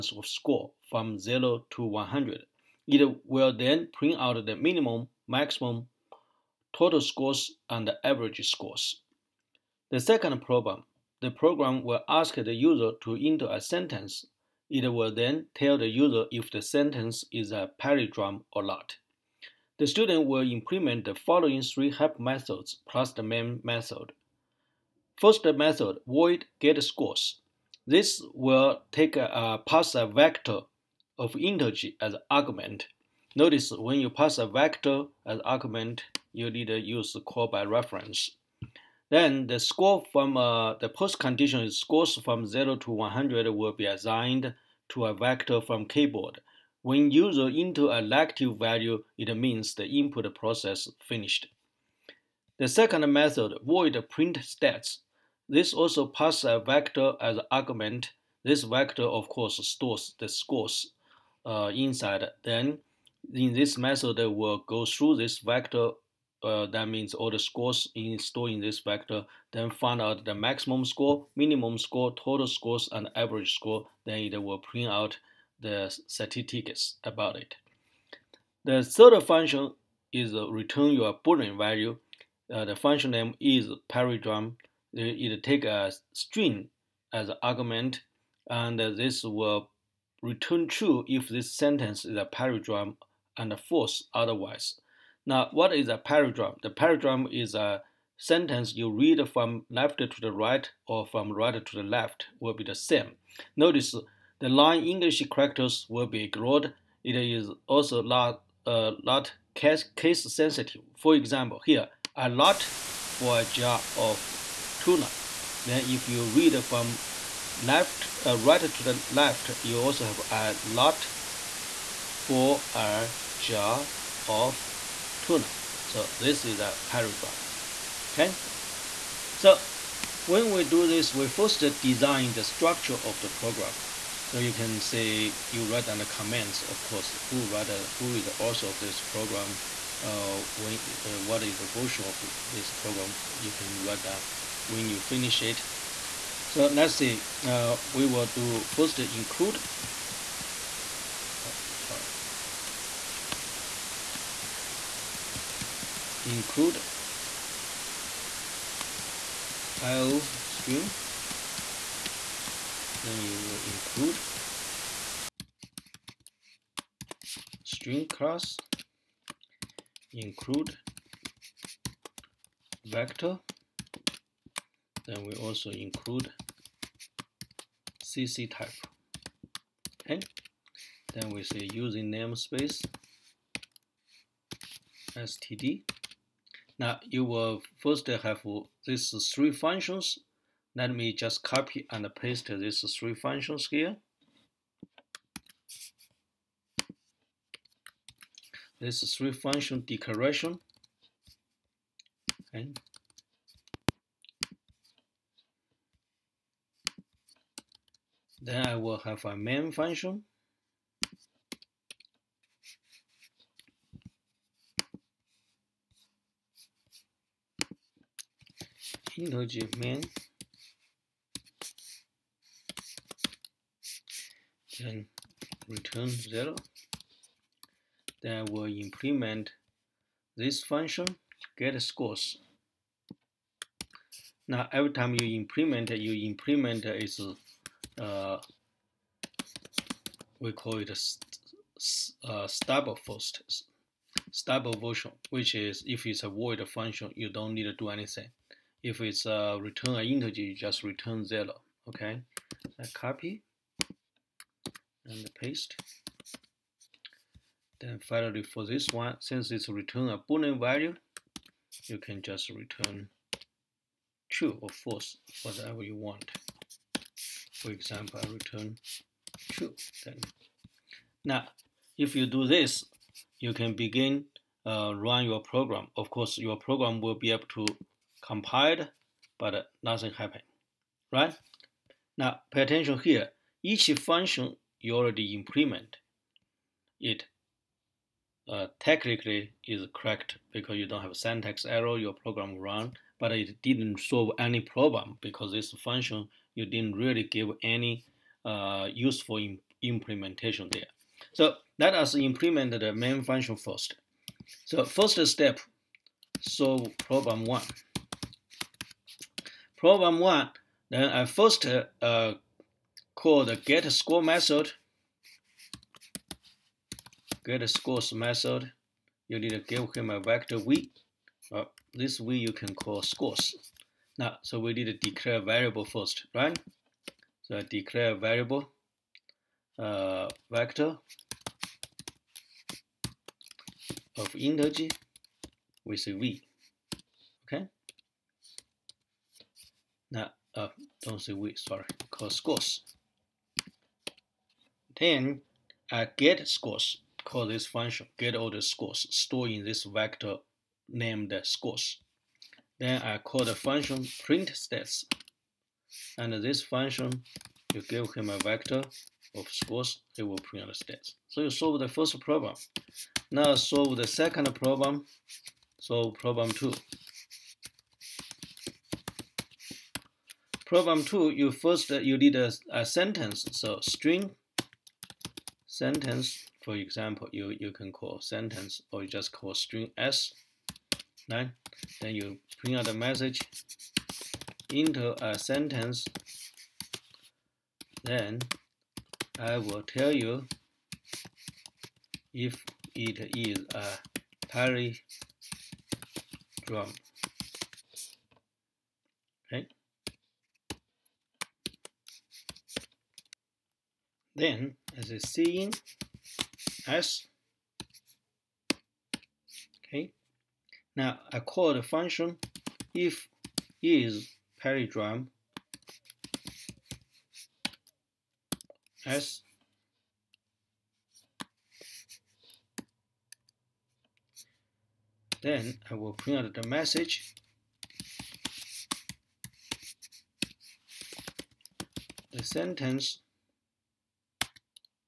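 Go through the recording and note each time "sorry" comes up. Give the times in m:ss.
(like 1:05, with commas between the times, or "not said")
2:31, 5:41.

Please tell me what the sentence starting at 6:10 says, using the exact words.
Problem two, you first, uh, you need a, a sentence.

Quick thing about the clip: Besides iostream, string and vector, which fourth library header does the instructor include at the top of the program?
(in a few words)
cctype.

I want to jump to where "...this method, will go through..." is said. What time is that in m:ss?
1:03.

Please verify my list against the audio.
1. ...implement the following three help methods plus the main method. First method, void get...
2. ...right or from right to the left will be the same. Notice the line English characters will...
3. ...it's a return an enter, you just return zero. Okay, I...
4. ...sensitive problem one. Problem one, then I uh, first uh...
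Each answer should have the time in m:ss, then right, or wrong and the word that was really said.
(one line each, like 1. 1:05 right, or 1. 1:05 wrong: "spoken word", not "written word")
1. 0:20 right
2. 1:40 right
3. 4:09 wrong: "integer", not "enter"
4. 5:06 wrong: "solve", not "sensitive".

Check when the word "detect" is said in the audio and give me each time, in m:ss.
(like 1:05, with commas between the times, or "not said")
not said.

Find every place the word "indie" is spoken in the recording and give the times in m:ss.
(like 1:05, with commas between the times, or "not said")
not said.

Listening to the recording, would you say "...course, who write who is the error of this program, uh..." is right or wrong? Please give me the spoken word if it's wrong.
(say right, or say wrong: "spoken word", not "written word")
wrong: "author", not "error".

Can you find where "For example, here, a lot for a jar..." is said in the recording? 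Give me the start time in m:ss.
1:50.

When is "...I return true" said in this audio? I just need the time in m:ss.
4:28.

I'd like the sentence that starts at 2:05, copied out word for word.
So this is a pyrite Okay.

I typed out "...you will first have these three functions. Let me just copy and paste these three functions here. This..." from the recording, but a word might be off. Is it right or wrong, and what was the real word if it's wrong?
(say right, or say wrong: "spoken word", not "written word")
right.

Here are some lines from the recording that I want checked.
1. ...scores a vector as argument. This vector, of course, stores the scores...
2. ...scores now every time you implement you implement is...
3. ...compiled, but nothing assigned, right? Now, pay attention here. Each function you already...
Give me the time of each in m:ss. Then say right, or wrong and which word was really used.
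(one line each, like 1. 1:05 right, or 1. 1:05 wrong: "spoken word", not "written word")
1. 0:56 wrong: "passes", not "scores"
2. 3:51 right
3. 4:38 wrong: "happened", not "assigned".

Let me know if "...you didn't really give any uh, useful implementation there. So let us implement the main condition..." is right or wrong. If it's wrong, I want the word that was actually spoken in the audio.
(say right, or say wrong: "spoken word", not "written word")
wrong: "function", not "condition".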